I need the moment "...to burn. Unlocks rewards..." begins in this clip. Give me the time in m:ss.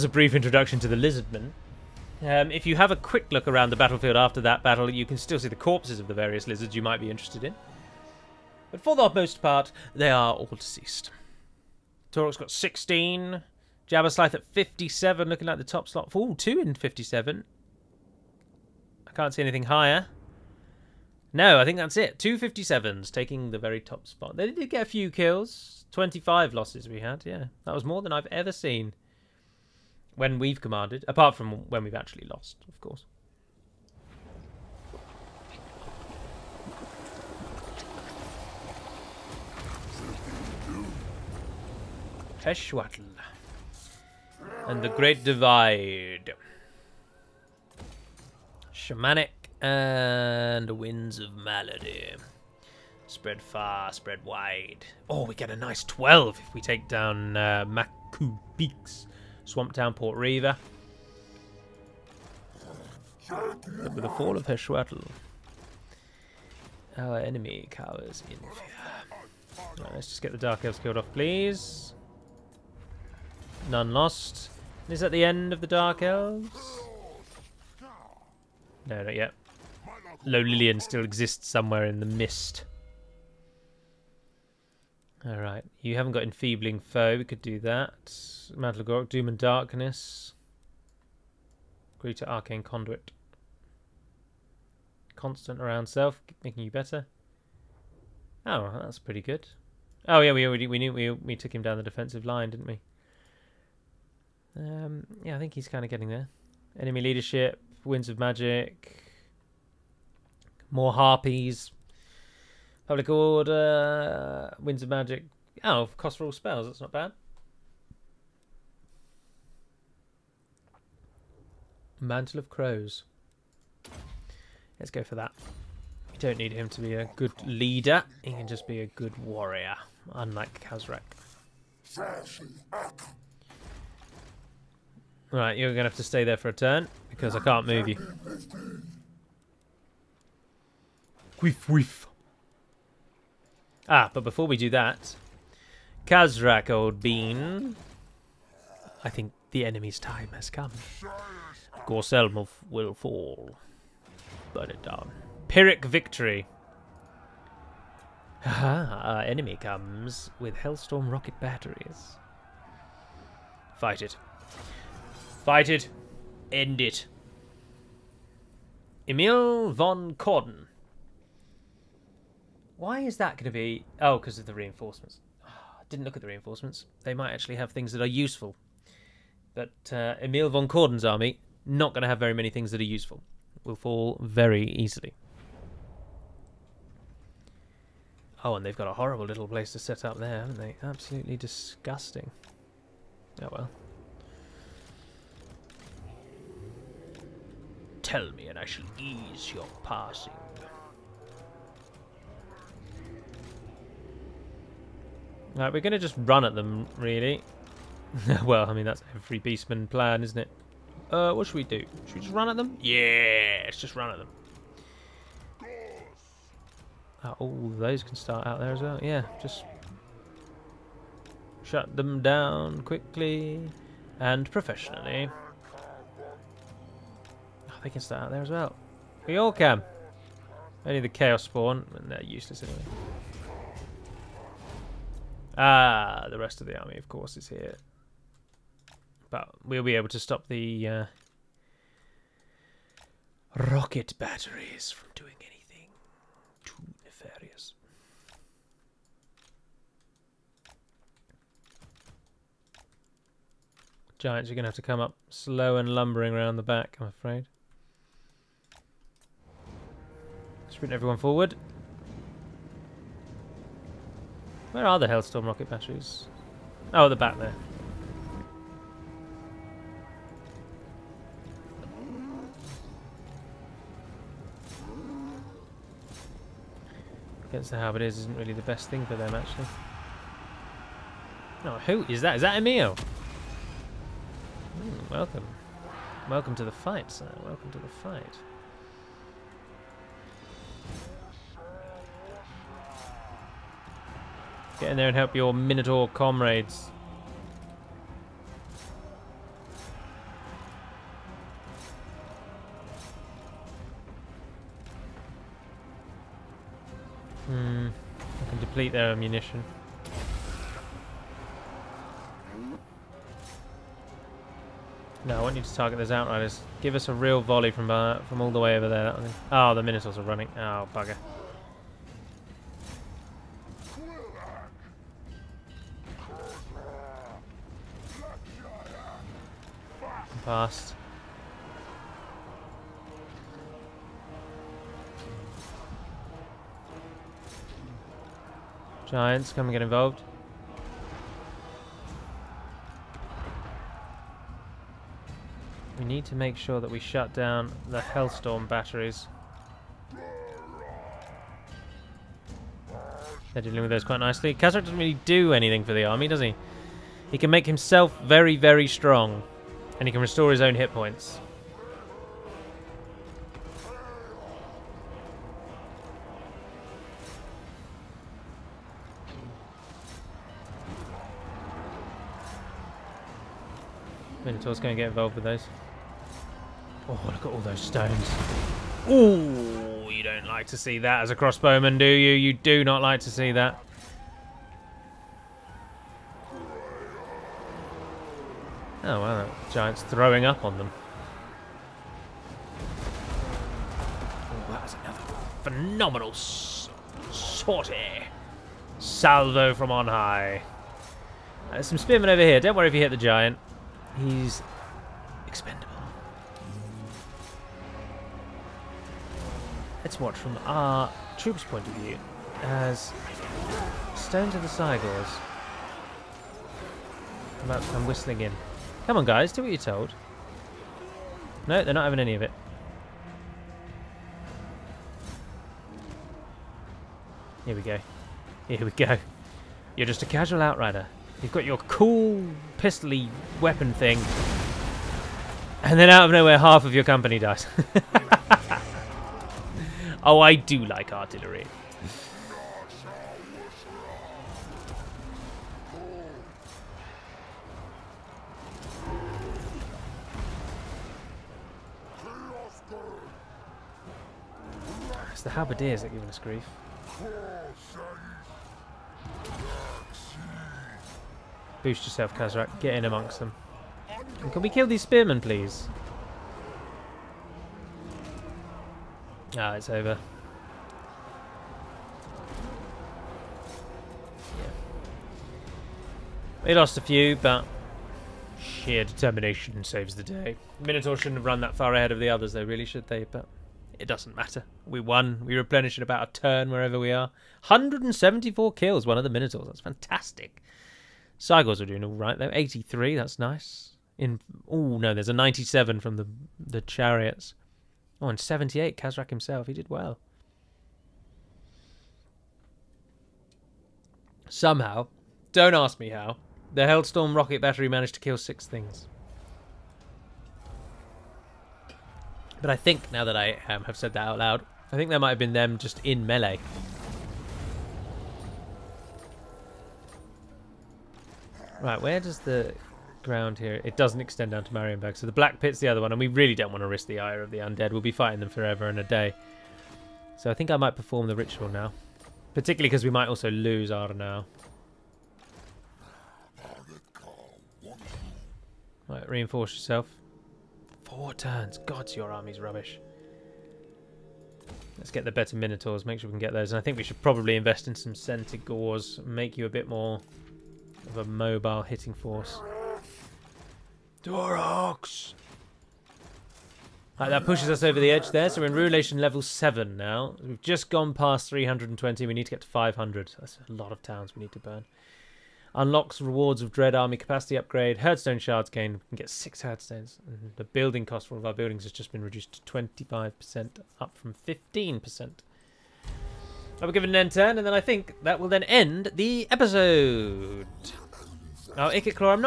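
9:24.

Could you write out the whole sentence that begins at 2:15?
Right, you're going to have to stay there for a turn, because I can't move you.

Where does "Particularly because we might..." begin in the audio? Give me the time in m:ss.
8:52.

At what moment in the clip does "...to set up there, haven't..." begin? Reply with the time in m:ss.
3:09.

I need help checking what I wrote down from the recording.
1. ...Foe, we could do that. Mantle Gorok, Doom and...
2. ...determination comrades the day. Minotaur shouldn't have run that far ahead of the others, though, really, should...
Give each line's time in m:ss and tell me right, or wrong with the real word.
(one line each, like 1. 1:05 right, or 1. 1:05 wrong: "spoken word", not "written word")
1. 1:26 right
2. 7:59 wrong: "saves", not "comrades".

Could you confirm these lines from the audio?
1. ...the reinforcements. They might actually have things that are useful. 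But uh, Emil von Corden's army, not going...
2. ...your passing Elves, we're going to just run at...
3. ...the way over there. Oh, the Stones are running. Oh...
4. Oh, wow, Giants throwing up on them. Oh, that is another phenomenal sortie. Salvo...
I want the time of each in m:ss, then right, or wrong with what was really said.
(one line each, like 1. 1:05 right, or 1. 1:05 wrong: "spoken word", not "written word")
1. 2:56 right
2. 3:19 wrong: "Right", not "Elves"
3. 5:18 wrong: "Minotaurs", not "Stones"
4. 6:29 right.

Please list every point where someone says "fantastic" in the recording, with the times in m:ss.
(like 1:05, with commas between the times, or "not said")
8:09.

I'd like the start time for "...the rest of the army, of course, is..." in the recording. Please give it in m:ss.
3:56.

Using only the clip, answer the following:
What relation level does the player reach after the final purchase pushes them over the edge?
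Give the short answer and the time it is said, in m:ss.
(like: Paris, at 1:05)
7, at 9:19.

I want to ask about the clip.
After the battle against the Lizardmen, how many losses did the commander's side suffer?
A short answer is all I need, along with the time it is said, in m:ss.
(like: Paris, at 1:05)
25, at 0:25.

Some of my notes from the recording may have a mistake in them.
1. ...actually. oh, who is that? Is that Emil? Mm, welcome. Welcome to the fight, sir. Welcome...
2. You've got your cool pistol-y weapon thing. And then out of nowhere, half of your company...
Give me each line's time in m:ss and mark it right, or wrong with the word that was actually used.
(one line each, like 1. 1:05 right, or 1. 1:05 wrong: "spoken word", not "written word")
1. 4:39 right
2. 7:11 right.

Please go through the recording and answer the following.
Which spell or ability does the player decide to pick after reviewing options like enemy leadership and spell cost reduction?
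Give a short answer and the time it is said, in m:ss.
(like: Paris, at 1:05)
Mantle of Crows, at 2:02.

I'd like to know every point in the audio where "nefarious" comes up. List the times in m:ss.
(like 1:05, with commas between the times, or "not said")
4:07.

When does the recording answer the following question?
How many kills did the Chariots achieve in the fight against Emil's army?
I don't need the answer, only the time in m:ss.
8:15.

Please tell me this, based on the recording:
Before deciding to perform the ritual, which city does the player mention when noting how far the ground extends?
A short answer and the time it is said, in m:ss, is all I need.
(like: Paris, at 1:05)
Marienburg, at 8:44.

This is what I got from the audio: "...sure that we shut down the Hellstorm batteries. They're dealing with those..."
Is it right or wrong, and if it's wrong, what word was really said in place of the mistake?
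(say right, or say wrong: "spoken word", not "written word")
right.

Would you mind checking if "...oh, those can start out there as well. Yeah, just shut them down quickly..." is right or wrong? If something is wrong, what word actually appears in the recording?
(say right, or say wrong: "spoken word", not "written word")
right.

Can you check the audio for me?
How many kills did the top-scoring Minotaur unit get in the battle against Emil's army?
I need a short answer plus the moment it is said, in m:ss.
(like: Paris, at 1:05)
174, at 8:07.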